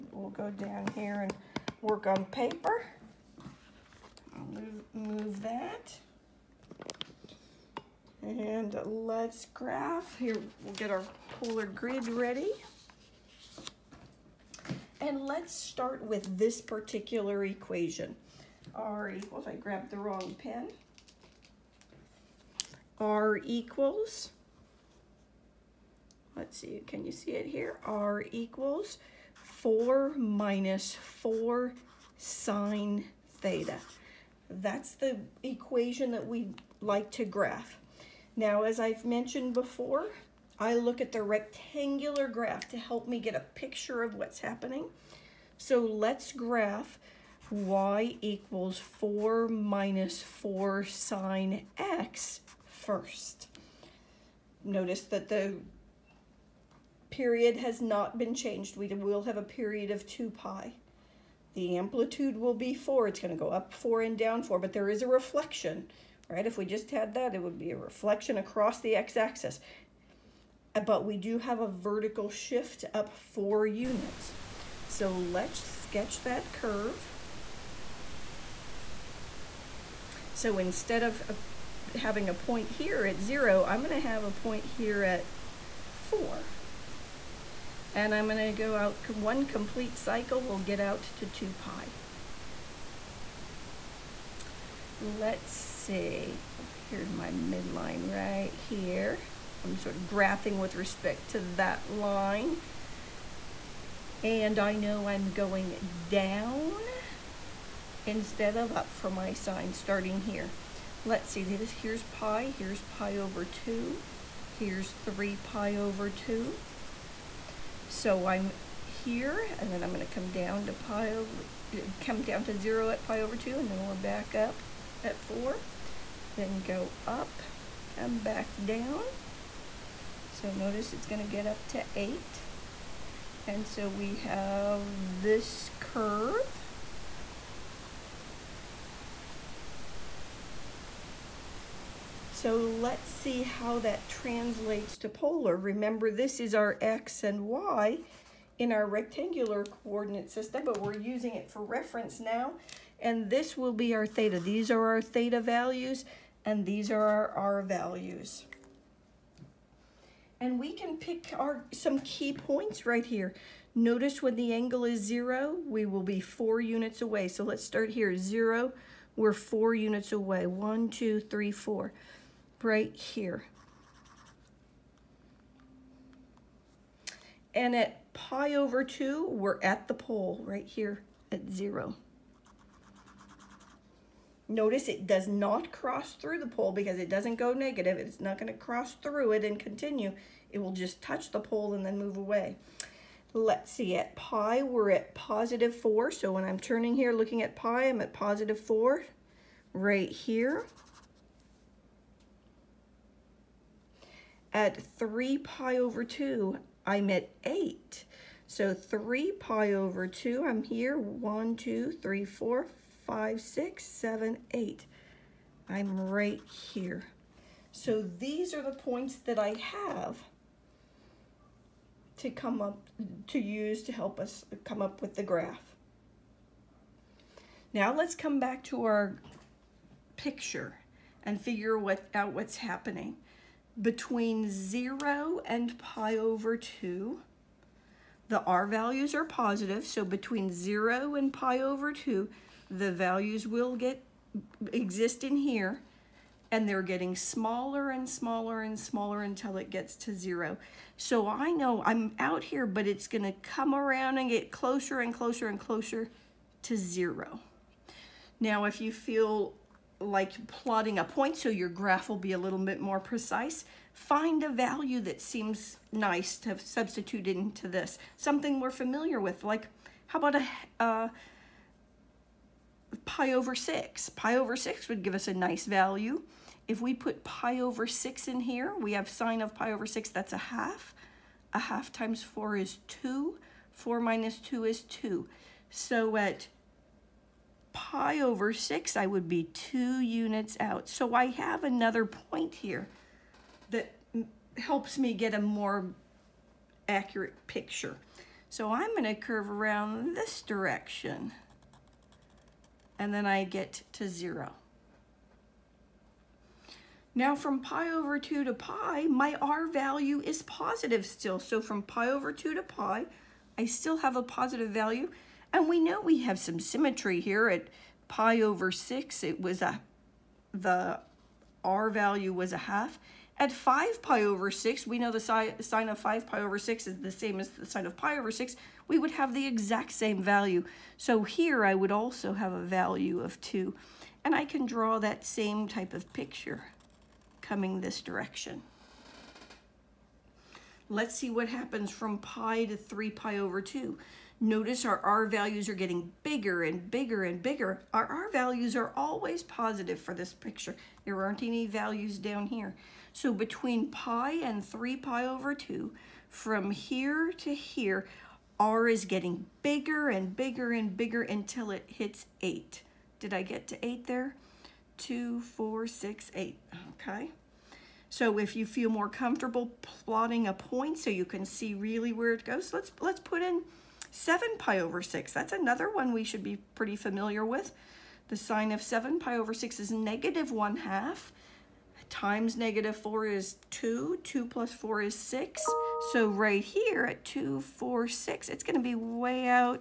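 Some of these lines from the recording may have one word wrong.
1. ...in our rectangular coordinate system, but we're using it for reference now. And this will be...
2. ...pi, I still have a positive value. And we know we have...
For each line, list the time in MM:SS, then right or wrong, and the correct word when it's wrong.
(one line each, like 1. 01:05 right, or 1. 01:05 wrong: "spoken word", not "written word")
1. 02:28 right
2. 05:12 right.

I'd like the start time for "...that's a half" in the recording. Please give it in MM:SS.
04:40.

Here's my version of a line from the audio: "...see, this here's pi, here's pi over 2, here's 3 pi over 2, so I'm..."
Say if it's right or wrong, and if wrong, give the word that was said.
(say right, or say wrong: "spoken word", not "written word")
right.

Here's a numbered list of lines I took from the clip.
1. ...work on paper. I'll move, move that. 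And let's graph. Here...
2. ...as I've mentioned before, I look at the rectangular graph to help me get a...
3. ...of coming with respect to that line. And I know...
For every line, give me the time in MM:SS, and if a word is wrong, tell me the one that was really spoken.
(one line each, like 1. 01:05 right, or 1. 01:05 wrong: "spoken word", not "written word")
1. 00:01 right
2. 00:38 right
3. 01:39 wrong: "graphing", not "coming".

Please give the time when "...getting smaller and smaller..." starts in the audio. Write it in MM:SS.
04:06.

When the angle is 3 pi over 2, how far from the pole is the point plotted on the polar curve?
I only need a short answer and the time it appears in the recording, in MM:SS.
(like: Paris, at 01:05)
8, at 03:26.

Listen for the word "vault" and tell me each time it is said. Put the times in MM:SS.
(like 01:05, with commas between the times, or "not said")
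not said.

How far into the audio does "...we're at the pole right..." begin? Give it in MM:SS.
02:59.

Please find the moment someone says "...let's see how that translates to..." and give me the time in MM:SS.
02:22.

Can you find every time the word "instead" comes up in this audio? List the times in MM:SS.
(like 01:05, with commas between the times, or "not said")
01:20, 01:48.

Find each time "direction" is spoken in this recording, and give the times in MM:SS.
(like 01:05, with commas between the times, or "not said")
05:00, 05:37.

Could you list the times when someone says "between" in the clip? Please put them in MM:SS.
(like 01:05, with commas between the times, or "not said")
03:53, 04:00, 05:53.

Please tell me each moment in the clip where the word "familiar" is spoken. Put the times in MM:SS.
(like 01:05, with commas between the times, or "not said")
04:28, 06:16.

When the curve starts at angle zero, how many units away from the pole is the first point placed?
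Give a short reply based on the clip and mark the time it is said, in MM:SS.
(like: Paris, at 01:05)
4, at 02:49.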